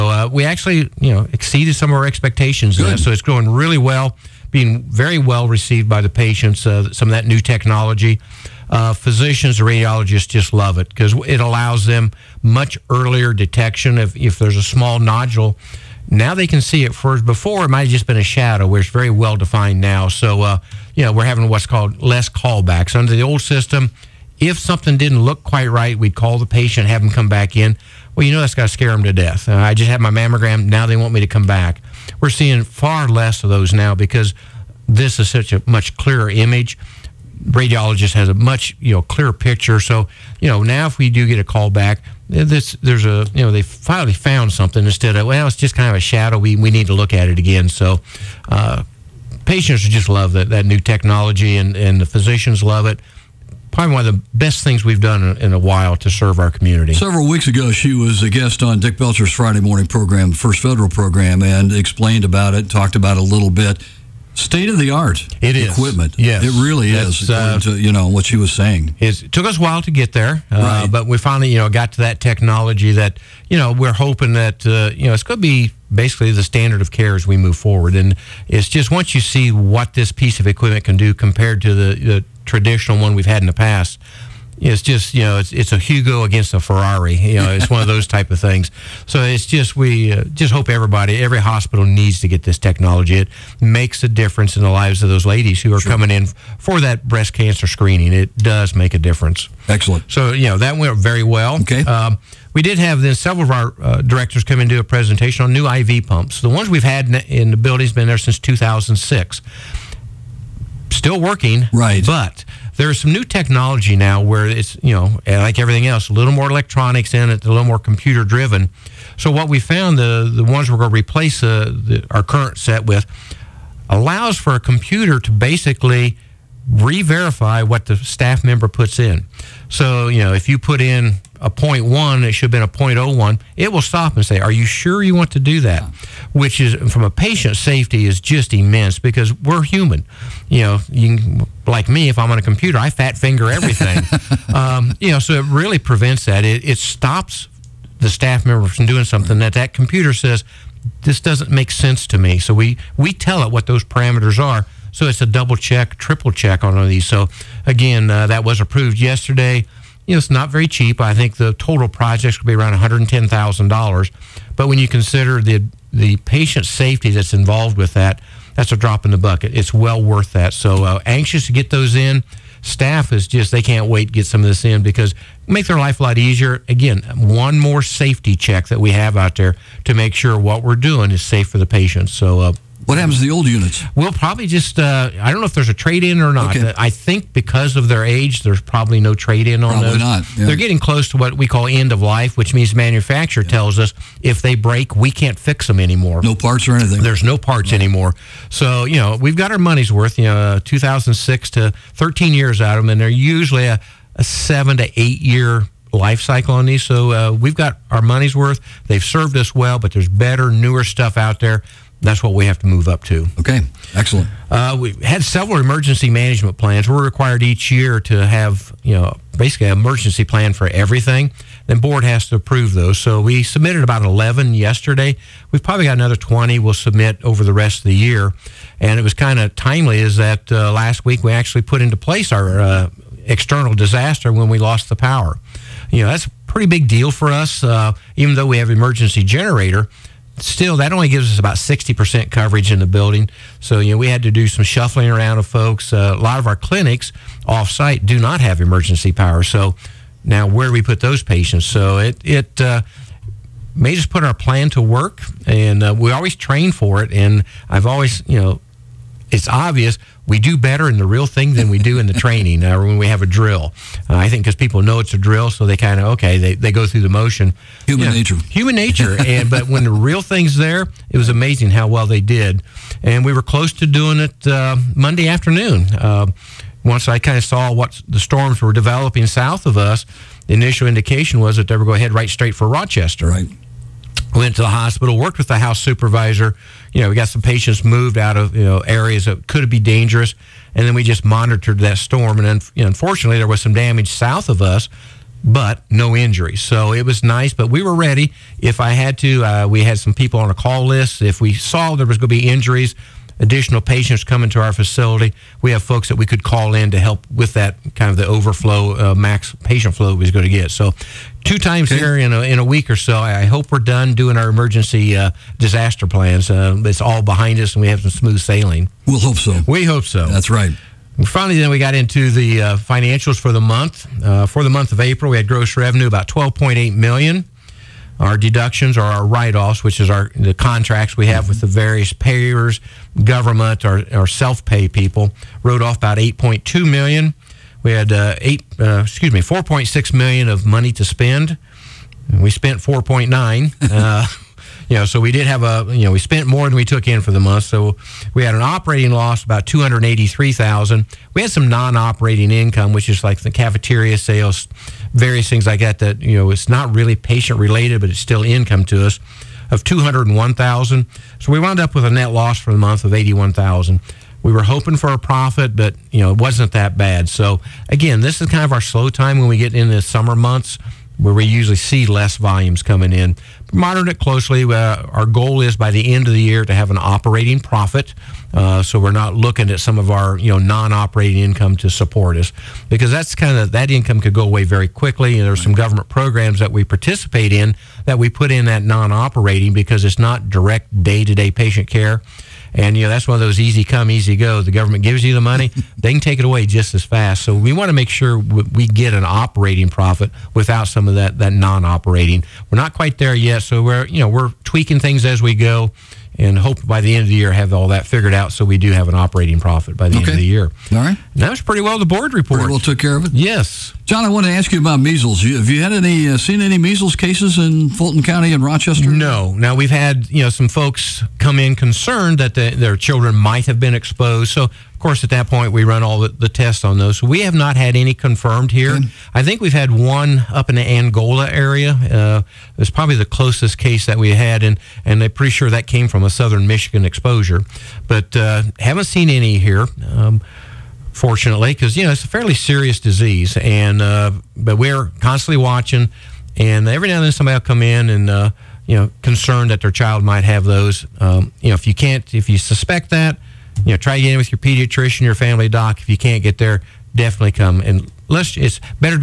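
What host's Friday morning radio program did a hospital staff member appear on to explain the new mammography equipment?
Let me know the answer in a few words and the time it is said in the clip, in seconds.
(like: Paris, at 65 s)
Dick Belcher, at 58 s.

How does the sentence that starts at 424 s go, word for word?
So of course, at that point, we run all the, the tests on those.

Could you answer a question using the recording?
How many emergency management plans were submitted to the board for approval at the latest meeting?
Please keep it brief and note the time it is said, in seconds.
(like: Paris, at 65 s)
11, at 223 s.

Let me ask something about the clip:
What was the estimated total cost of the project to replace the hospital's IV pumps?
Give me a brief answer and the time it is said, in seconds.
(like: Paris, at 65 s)
$110,000, at 162 s.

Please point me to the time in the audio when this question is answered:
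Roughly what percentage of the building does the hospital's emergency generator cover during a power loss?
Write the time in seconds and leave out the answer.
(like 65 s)
241 s.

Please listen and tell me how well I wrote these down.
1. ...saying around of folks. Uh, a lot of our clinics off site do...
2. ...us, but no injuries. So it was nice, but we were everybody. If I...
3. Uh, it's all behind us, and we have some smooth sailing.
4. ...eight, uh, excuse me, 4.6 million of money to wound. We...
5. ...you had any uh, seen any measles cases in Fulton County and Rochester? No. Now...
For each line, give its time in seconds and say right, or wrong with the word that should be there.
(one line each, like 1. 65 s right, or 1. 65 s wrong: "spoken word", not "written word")
1. 244 s wrong: "shuffling", not "saying"
2. 294 s wrong: "ready", not "everybody"
3. 316 s right
4. 338 s wrong: "spend", not "wound"
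5. 415 s right.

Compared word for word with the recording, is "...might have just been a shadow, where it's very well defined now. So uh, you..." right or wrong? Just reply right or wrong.
right.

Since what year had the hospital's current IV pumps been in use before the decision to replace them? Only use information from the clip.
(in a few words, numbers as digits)
2006.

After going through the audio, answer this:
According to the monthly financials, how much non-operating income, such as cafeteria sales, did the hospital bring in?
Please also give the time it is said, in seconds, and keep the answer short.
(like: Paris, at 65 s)
201,000, at 359 s.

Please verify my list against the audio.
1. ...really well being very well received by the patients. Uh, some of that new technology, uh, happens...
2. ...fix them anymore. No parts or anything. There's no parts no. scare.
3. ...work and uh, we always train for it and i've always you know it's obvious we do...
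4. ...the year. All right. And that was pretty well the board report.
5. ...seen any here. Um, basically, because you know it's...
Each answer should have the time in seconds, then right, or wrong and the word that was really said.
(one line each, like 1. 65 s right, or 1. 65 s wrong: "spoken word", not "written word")
1. 3 s wrong: "physicians", not "happens"
2. 195 s wrong: "anymore", not "scare"
3. 254 s right
4. 410 s right
5. 439 s wrong: "fortunately", not "basically".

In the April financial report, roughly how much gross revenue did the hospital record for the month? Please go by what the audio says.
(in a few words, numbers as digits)
12.8 million.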